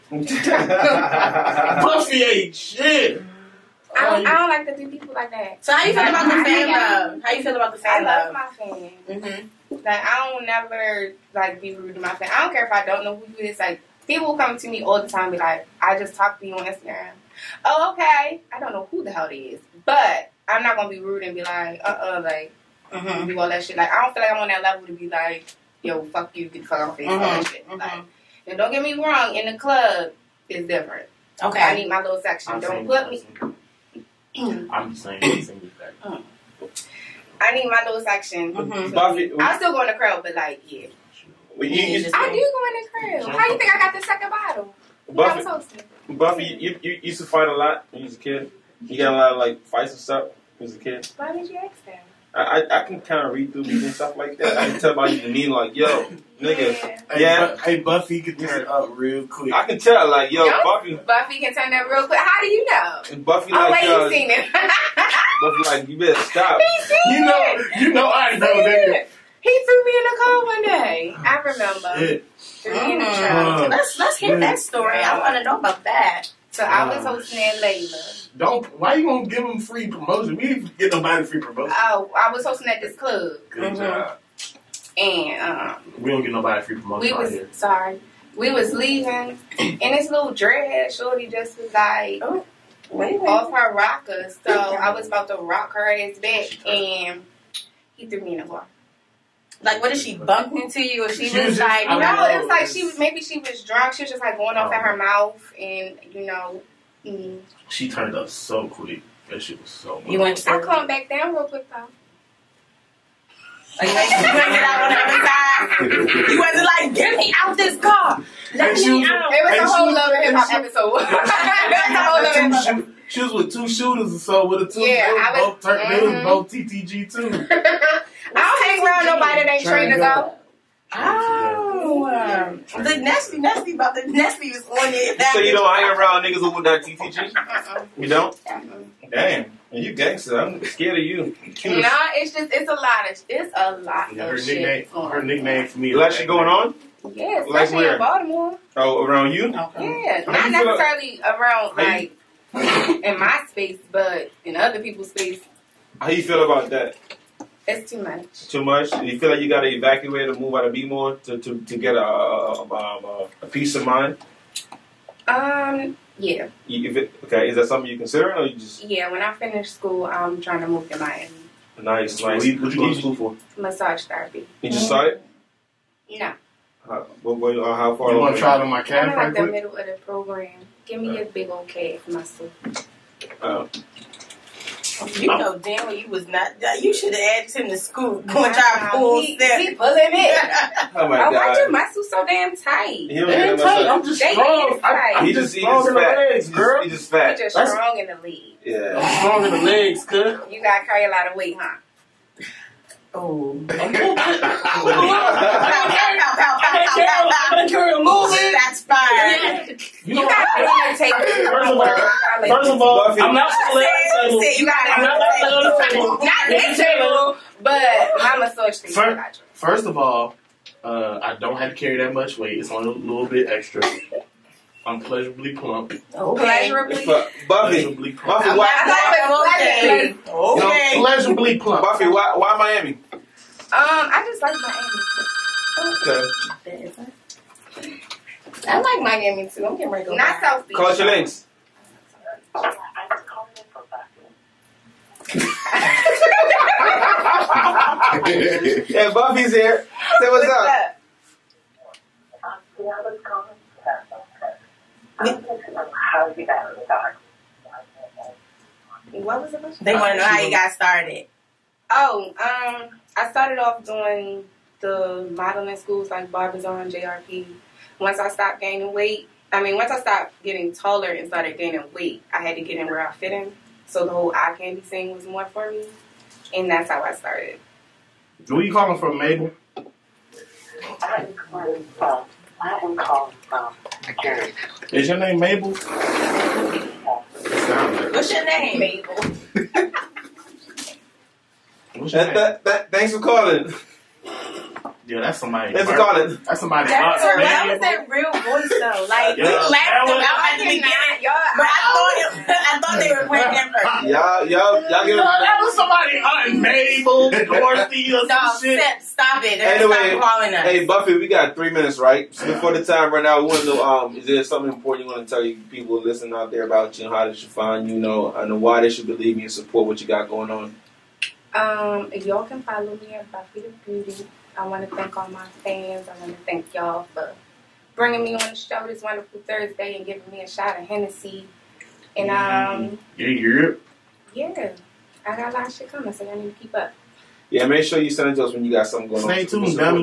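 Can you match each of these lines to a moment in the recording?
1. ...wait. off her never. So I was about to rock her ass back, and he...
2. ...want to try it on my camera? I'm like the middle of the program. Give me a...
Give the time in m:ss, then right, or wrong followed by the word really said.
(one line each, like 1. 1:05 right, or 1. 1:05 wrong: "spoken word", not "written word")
1. 1:33 wrong: "rocker", not "never"
2. 2:58 right.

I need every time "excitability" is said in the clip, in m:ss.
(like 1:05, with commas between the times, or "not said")
not said.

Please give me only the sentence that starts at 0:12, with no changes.
I don't care if I don't know who you is.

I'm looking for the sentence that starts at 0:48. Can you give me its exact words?
You got a lot of like fights and stuff as a kid.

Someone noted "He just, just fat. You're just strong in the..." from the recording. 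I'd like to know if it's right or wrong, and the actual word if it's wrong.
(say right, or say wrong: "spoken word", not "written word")
right.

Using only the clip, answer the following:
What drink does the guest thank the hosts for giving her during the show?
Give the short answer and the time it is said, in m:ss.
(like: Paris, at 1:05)
Hennessy, at 5:30.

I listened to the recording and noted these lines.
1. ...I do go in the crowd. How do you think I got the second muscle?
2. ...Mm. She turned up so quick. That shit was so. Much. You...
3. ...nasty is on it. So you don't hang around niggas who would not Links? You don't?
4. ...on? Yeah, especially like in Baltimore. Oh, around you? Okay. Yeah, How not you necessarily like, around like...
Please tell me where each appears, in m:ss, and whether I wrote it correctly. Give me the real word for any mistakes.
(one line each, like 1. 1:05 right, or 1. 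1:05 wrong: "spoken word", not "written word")
1. 0:42 wrong: "bottle", not "muscle"
2. 1:47 right
3. 2:14 wrong: "TTG", not "Links"
4. 2:26 right.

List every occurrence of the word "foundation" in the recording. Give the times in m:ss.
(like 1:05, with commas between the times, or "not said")
not said.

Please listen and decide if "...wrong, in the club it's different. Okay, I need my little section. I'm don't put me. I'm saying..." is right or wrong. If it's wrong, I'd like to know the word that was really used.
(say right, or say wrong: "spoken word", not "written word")
right.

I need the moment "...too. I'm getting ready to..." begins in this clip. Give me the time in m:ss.
3:59.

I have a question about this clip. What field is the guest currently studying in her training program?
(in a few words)
Massage therapy.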